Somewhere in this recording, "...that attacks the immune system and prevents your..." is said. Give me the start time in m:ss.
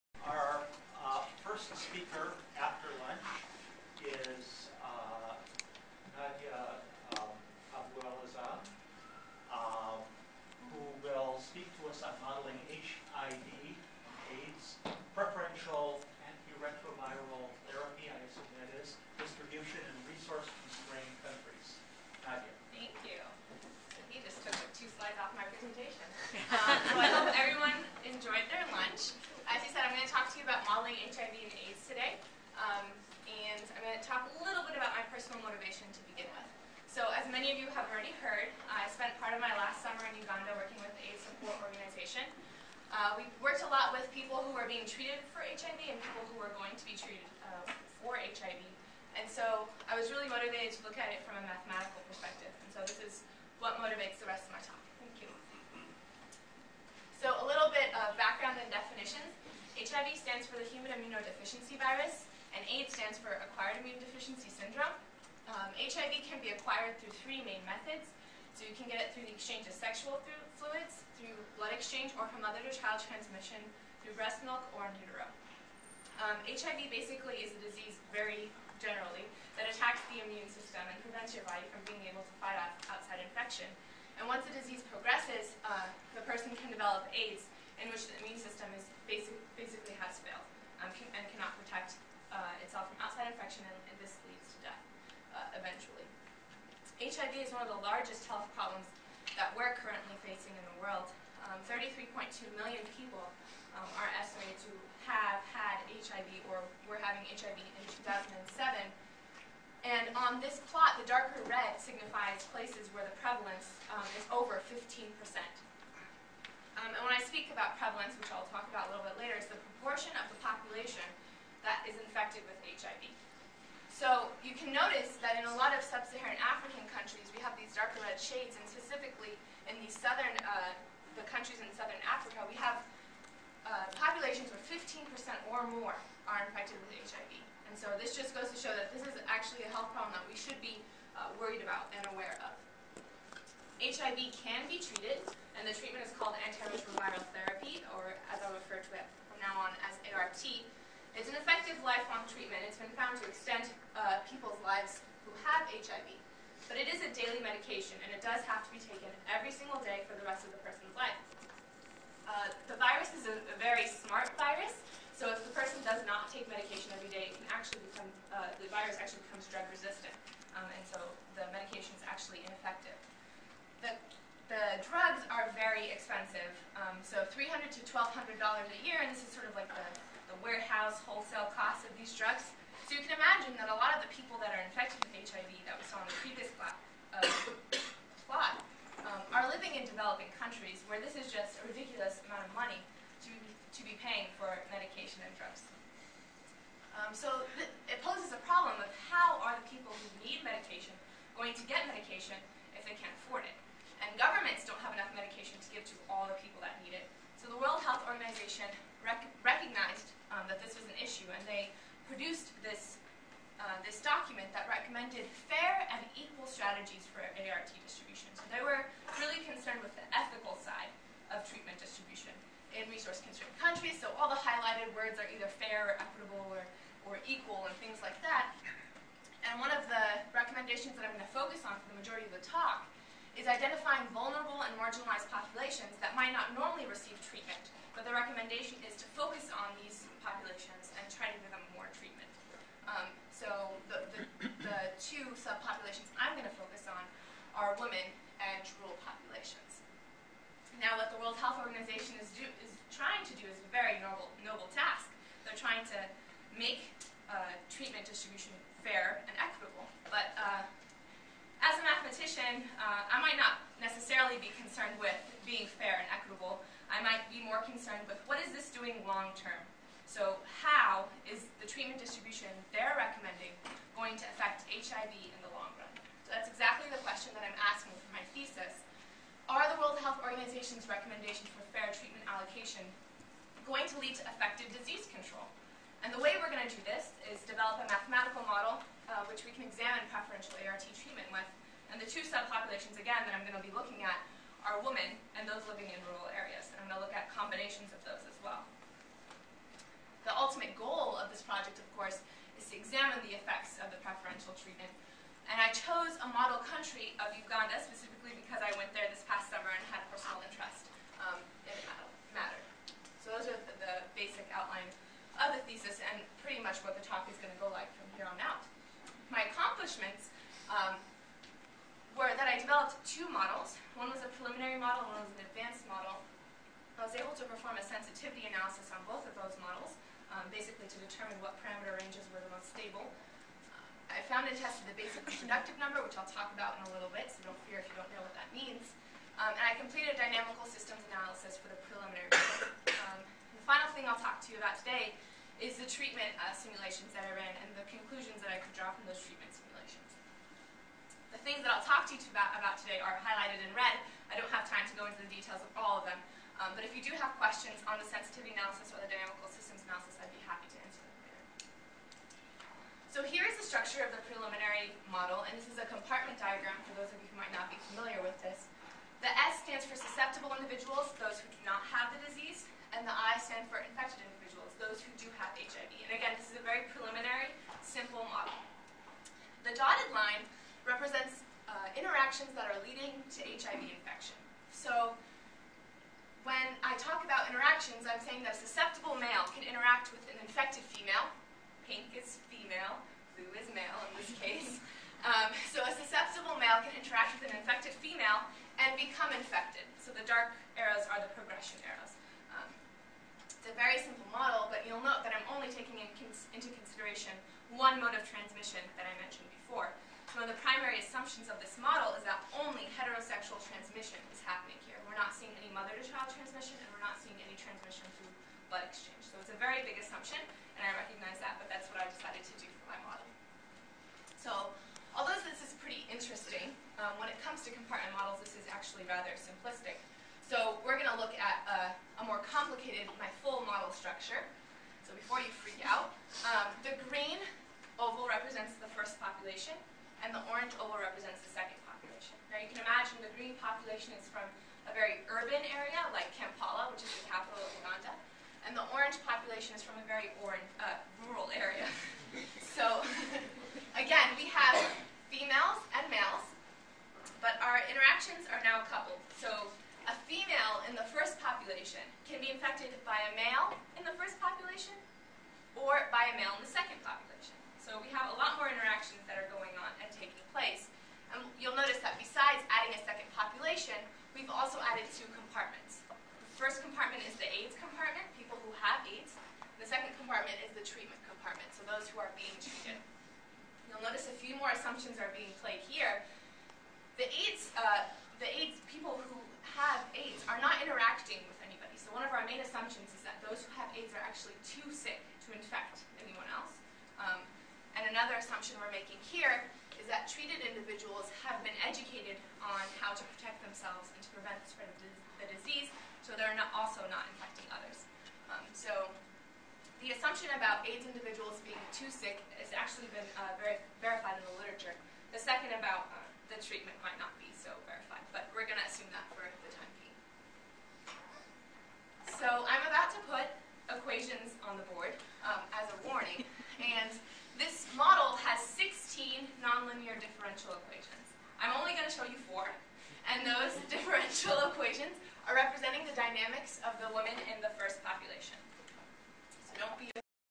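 1:19.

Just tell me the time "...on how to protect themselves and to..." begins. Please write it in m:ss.
8:22.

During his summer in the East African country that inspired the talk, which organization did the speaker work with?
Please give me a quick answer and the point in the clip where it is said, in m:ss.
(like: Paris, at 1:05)
The AIDS Support Organization, at 0:40.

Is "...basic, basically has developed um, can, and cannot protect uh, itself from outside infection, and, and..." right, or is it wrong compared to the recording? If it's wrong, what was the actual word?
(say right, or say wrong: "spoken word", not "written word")
wrong: "failed", not "developed".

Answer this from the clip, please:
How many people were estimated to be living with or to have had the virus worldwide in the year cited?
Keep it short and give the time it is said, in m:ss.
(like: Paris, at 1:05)
33.2 million, at 1:41.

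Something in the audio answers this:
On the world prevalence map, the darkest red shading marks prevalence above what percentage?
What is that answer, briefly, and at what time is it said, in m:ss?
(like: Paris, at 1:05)
15%, at 1:54.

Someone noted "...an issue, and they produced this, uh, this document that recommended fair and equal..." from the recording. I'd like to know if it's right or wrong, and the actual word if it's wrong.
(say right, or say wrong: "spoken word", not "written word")
right.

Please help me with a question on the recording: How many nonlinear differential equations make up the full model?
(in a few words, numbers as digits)
16.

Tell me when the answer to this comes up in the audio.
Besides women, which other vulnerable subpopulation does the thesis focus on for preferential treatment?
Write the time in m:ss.
4:08.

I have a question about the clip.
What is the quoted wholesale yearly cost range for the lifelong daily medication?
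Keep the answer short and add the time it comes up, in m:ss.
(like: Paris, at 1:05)
$300 to $1,200, at 2:57.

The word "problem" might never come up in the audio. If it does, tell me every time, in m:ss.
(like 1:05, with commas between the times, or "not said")
1:38, 2:19, 3:18.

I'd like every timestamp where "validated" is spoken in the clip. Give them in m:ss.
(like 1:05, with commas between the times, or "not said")
not said.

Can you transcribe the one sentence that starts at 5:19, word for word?
My accomplishments um, developed two models.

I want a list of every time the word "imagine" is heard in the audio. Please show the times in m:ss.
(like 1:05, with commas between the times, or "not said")
3:03, 7:22.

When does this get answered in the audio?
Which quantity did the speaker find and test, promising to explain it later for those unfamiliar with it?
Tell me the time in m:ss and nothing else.
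5:34.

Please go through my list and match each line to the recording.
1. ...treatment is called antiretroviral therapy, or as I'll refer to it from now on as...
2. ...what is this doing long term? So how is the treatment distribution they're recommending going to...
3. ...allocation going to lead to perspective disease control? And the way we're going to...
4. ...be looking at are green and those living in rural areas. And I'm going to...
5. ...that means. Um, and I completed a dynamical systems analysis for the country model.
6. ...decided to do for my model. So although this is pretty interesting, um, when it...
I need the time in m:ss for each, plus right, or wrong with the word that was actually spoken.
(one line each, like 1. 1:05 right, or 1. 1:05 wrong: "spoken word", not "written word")
1. 2:25 right
2. 4:28 right
3. 4:42 wrong: "effective", not "perspective"
4. 4:53 wrong: "women", not "green"
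5. 5:38 wrong: "preliminary", not "country"
6. 7:02 right.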